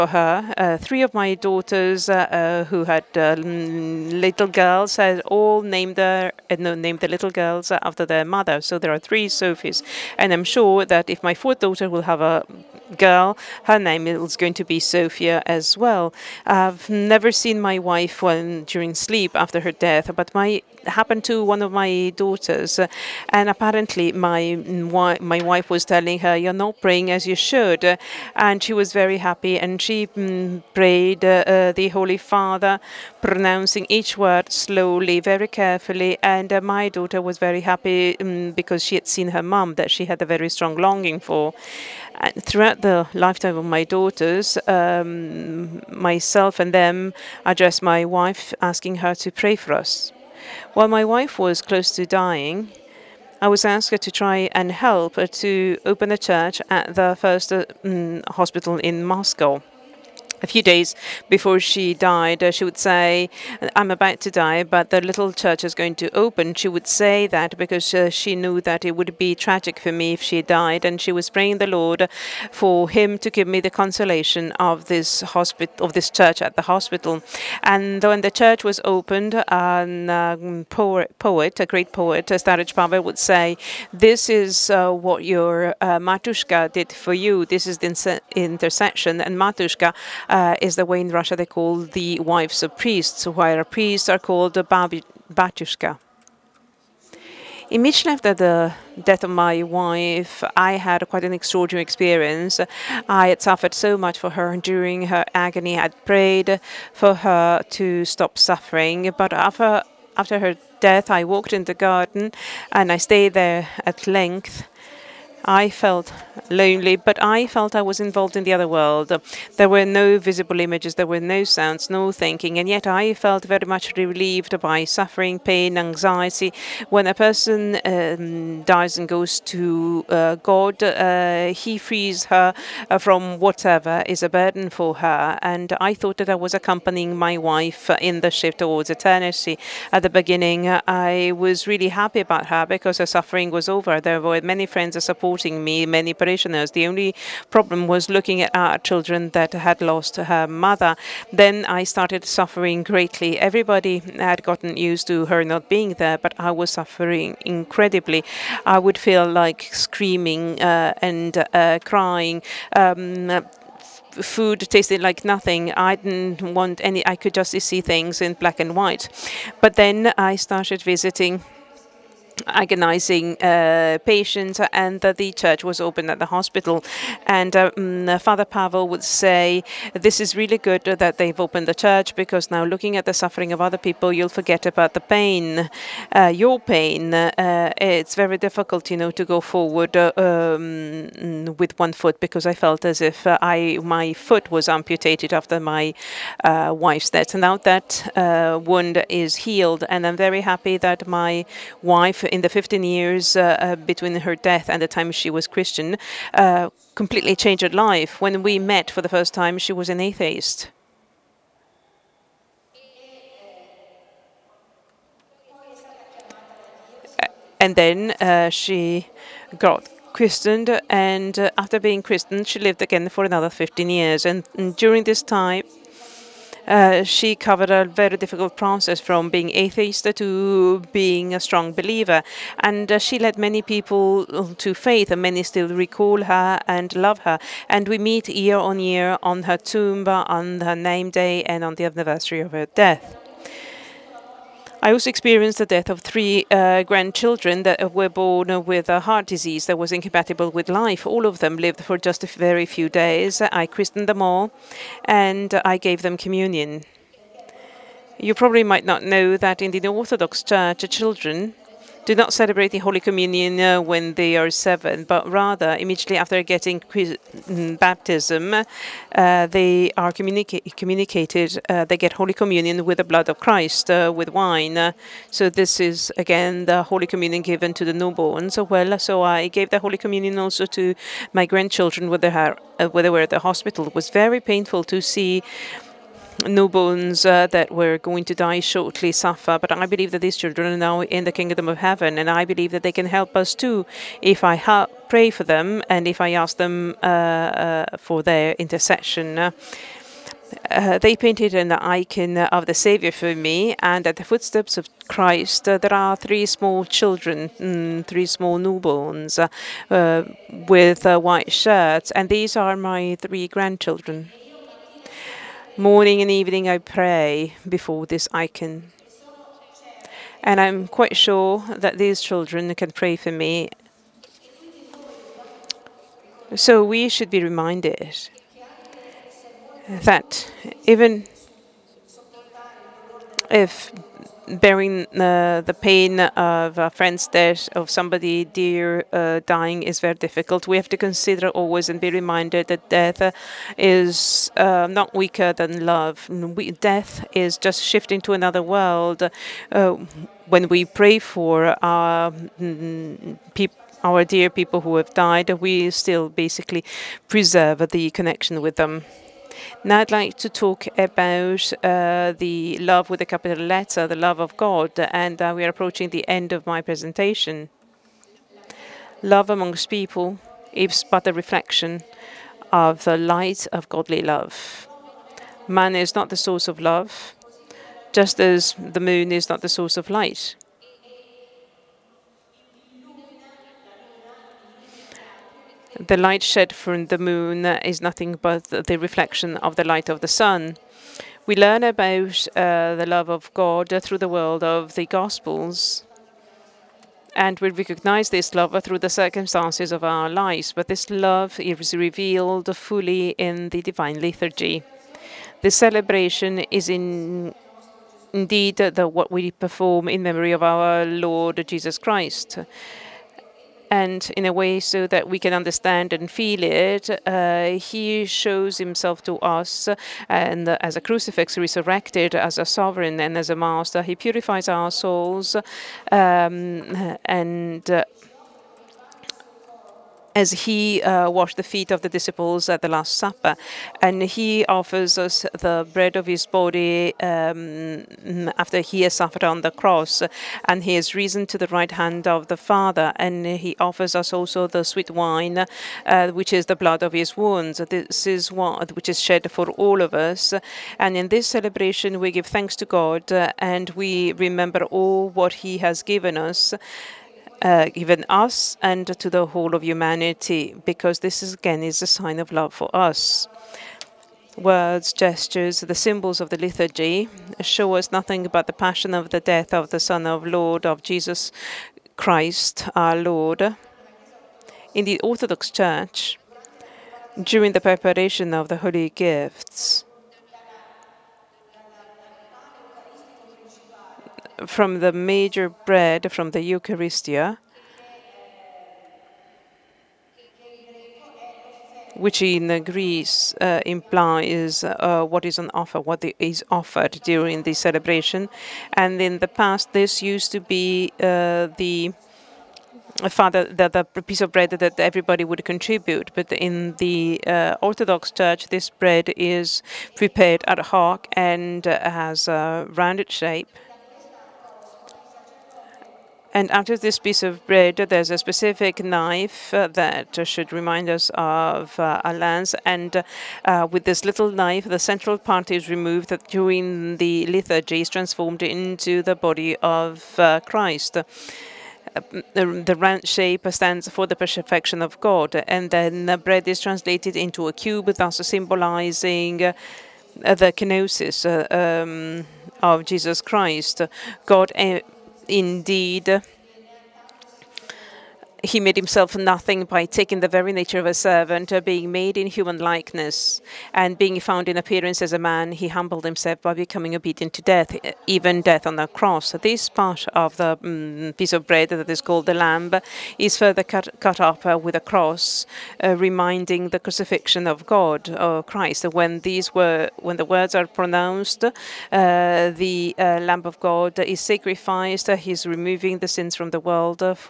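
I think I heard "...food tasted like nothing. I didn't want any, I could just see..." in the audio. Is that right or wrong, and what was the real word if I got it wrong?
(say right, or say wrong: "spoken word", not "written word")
right.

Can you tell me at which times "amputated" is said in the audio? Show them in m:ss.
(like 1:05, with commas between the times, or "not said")
3:14.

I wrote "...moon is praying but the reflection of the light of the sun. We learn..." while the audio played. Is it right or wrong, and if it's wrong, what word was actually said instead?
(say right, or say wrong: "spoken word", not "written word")
wrong: "nothing", not "praying".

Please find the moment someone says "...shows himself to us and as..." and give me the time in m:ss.
6:58.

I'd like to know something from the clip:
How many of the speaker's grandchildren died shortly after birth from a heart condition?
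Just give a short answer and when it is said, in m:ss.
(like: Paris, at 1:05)
3, at 4:06.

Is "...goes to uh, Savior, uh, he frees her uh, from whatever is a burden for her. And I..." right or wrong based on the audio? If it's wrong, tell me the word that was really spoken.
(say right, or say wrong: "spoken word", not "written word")
wrong: "God", not "Savior".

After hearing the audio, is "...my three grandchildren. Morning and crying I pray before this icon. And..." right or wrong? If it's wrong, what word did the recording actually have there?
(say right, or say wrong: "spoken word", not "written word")
wrong: "evening", not "crying".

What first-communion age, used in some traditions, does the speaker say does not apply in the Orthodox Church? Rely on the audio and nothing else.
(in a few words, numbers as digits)
7.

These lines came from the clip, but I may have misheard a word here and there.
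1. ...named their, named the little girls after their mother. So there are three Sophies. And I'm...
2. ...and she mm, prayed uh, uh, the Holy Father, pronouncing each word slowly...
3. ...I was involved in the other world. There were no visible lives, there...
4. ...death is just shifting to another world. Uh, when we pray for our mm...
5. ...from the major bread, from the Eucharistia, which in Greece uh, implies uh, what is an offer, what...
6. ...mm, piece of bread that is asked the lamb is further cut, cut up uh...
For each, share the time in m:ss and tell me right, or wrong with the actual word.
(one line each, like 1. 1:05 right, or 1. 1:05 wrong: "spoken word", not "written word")
1. 0:05 right
2. 0:29 right
3. 1:57 wrong: "images", not "lives"
4. 5:46 right
5. 8:04 right
6. 9:20 wrong: "called", not "asked".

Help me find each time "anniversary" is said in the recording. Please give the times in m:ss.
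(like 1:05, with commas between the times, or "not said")
4:01.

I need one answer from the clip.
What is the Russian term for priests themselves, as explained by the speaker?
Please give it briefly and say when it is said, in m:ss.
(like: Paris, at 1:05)
batyushka, at 1:34.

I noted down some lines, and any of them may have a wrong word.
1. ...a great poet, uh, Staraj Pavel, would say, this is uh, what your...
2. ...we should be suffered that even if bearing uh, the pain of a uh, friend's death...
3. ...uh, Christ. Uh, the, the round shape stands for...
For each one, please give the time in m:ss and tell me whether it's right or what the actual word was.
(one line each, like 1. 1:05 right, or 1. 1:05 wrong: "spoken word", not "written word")
1. 1:21 right
2. 5:26 wrong: "reminded", not "suffered"
3. 8:50 right.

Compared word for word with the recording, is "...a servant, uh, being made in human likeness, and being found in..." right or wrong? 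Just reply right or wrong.
right.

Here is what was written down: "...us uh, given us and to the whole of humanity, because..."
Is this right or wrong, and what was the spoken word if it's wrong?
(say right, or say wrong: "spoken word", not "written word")
right.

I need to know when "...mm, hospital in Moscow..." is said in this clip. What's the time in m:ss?
0:57.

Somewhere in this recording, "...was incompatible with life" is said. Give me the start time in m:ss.
4:09.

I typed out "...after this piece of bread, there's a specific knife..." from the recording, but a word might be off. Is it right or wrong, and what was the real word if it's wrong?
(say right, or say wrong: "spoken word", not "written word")
right.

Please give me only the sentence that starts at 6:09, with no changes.
Love amongst people is but a reflection of the light of godly love.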